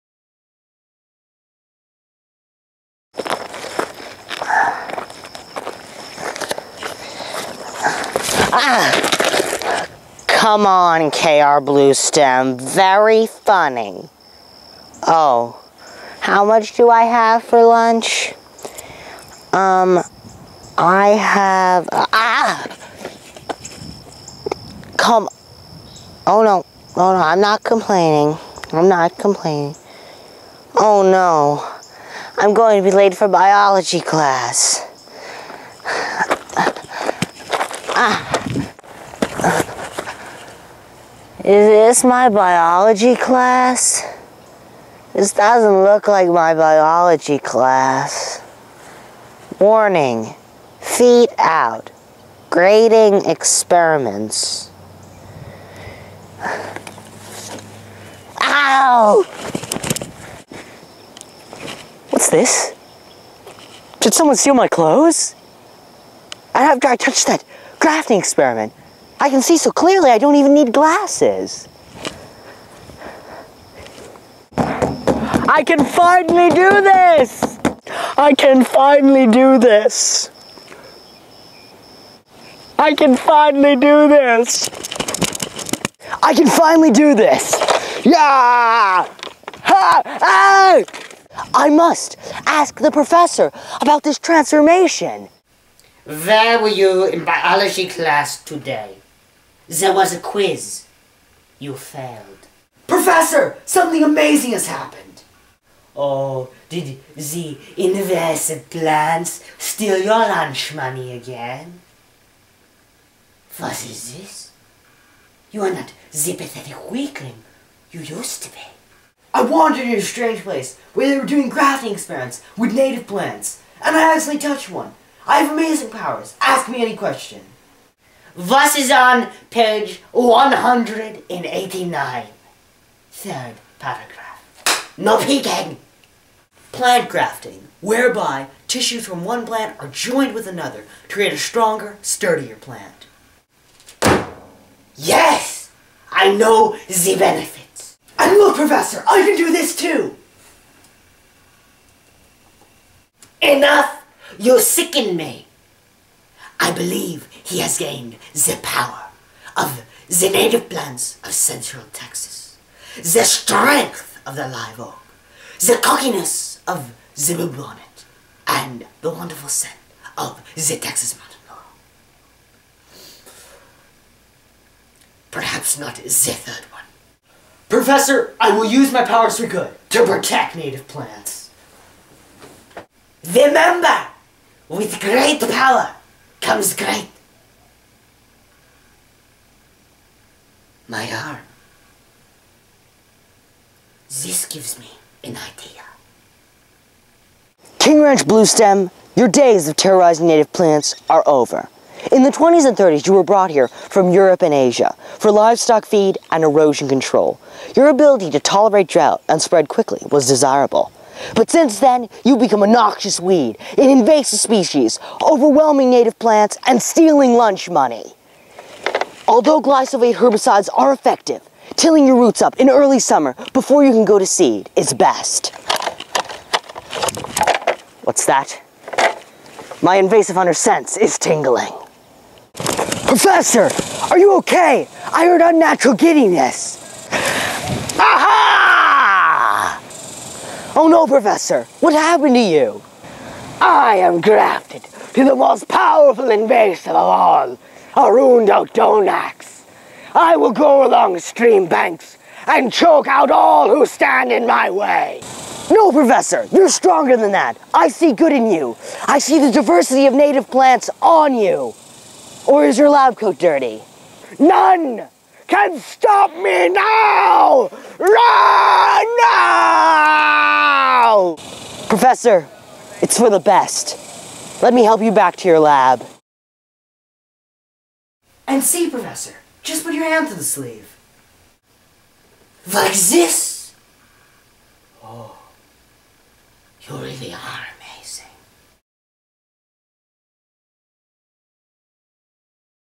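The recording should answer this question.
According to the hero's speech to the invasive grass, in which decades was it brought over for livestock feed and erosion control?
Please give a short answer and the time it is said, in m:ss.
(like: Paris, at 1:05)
20s and 30s, at 3:22.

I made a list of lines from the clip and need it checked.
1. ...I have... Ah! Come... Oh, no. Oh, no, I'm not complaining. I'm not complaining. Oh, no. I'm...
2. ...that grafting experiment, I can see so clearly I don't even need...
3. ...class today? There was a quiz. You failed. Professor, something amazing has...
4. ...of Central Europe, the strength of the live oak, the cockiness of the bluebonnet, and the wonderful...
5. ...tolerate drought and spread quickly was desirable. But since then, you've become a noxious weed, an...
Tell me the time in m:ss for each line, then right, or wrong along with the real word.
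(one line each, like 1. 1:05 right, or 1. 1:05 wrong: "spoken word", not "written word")
1. 0:20 right
2. 1:07 right
3. 1:37 right
4. 2:41 wrong: "Texas", not "Europe"
5. 3:28 right.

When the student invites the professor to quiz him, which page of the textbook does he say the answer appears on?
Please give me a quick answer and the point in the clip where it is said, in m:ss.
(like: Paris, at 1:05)
189, at 2:09.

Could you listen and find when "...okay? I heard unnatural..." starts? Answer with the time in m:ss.
3:54.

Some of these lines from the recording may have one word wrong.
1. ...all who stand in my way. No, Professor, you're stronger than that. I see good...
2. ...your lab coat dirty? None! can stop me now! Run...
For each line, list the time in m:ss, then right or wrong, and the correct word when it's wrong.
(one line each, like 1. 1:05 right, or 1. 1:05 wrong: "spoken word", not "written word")
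1. 4:13 right
2. 4:22 right.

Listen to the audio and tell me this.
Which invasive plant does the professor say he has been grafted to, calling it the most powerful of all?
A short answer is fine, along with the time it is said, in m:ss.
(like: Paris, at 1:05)
Arundo donax, at 4:08.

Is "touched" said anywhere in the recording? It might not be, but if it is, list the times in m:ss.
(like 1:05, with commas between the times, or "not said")
1:06, 2:04.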